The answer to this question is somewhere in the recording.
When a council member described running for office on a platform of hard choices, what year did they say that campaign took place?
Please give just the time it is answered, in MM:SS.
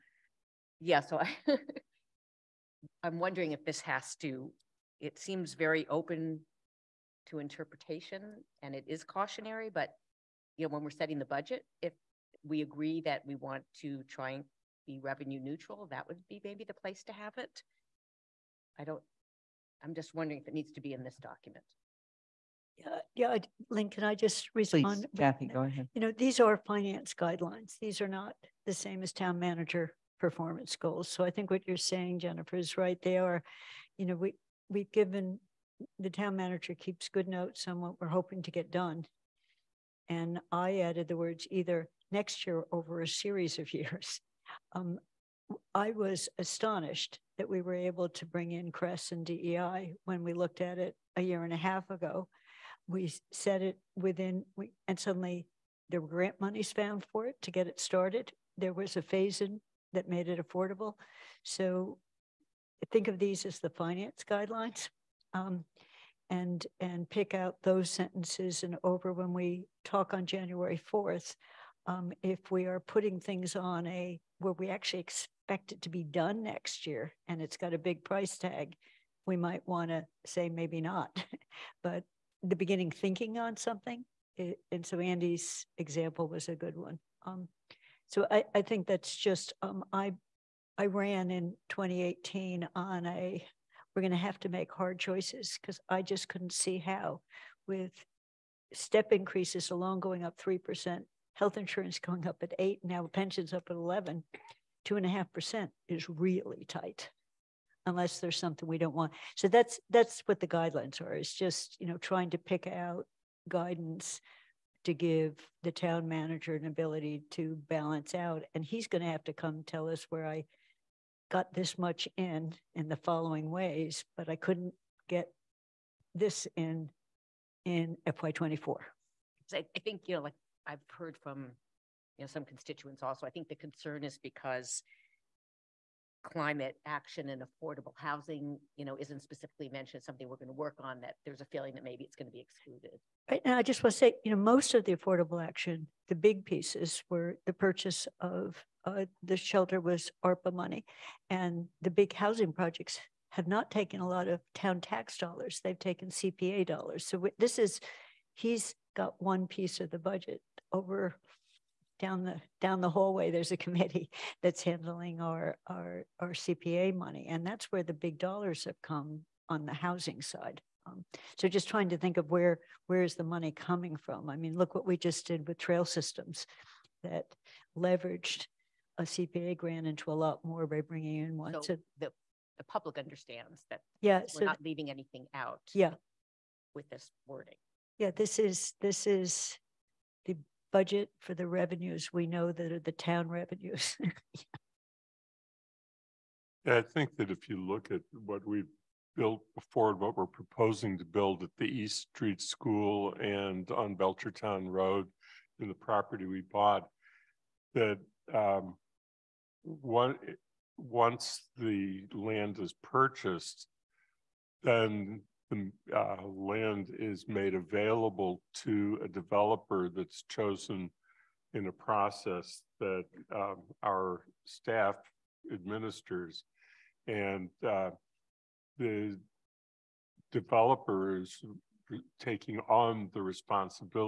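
01:31.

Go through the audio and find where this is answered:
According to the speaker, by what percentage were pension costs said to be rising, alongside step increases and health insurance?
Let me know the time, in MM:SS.
01:43.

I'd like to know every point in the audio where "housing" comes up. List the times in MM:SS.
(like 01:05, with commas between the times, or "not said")
02:17, 02:32, 02:49.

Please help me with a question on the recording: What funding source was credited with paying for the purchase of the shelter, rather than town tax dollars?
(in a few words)
ARPA money.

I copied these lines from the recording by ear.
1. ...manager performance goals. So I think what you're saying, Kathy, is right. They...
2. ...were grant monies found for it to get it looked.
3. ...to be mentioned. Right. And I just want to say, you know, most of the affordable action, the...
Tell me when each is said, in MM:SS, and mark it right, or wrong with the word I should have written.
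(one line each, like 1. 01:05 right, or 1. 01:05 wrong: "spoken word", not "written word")
1. 00:29 wrong: "Jennifer", not "Kathy"
2. 00:56 wrong: "started", not "looked"
3. 02:22 wrong: "excluded", not "mentioned".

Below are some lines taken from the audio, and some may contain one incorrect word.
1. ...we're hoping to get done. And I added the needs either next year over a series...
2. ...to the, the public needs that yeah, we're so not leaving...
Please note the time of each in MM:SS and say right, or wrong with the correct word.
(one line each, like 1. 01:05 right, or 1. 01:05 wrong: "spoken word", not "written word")
1. 00:38 wrong: "words", not "needs"
2. 03:01 wrong: "understands", not "needs".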